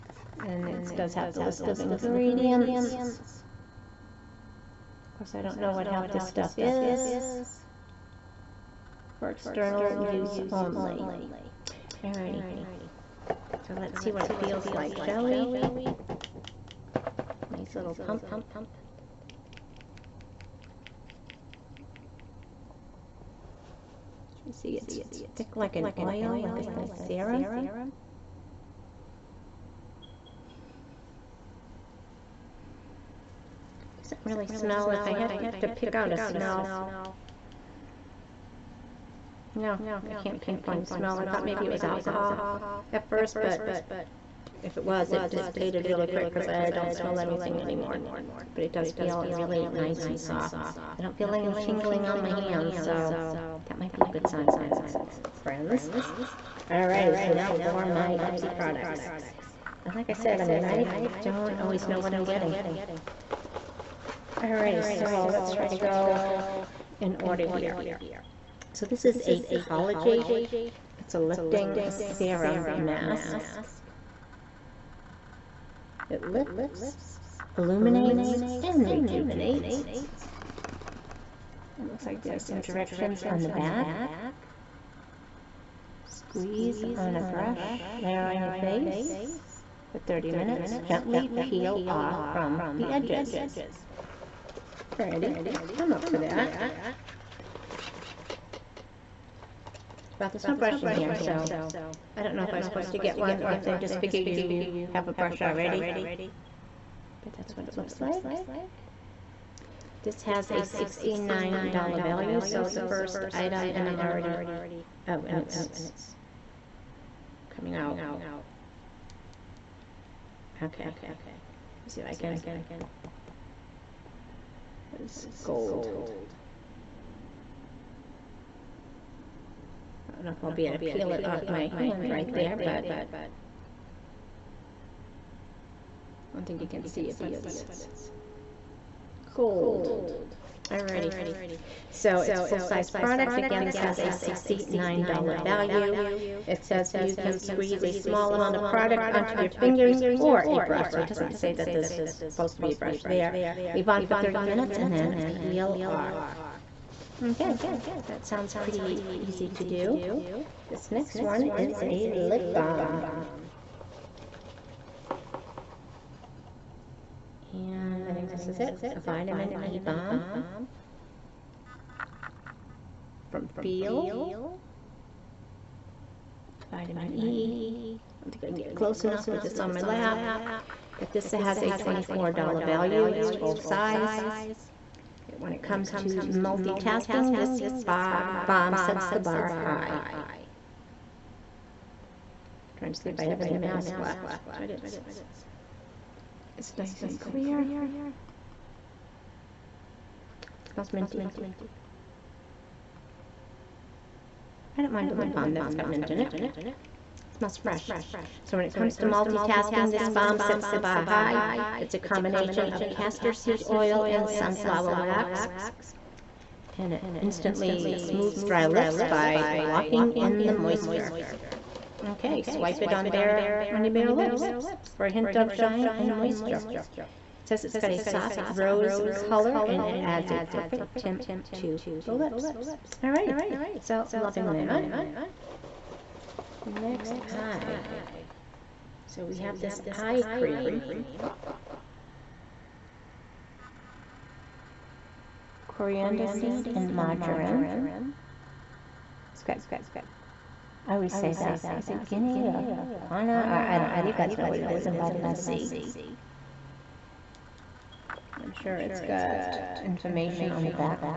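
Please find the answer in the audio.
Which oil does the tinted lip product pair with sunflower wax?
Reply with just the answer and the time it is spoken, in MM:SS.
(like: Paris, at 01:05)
castor seed oil, at 03:32.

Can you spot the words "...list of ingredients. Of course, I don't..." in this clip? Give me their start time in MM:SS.
00:01.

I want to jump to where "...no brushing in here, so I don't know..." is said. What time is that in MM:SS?
01:40.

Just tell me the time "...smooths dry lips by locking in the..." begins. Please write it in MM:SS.
03:37.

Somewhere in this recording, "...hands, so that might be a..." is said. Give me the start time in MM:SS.
00:52.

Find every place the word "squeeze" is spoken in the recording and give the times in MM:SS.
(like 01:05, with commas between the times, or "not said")
01:26, 02:27.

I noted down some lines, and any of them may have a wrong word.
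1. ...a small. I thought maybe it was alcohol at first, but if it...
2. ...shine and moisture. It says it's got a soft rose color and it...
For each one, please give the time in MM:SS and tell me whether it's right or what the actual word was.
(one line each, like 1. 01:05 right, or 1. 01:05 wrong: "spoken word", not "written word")
1. 00:40 wrong: "smell", not "small"
2. 03:45 right.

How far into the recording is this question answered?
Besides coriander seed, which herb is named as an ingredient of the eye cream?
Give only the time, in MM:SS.
04:06.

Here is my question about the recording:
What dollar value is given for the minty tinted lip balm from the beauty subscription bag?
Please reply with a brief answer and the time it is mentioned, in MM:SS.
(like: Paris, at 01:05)
$24, at 03:01.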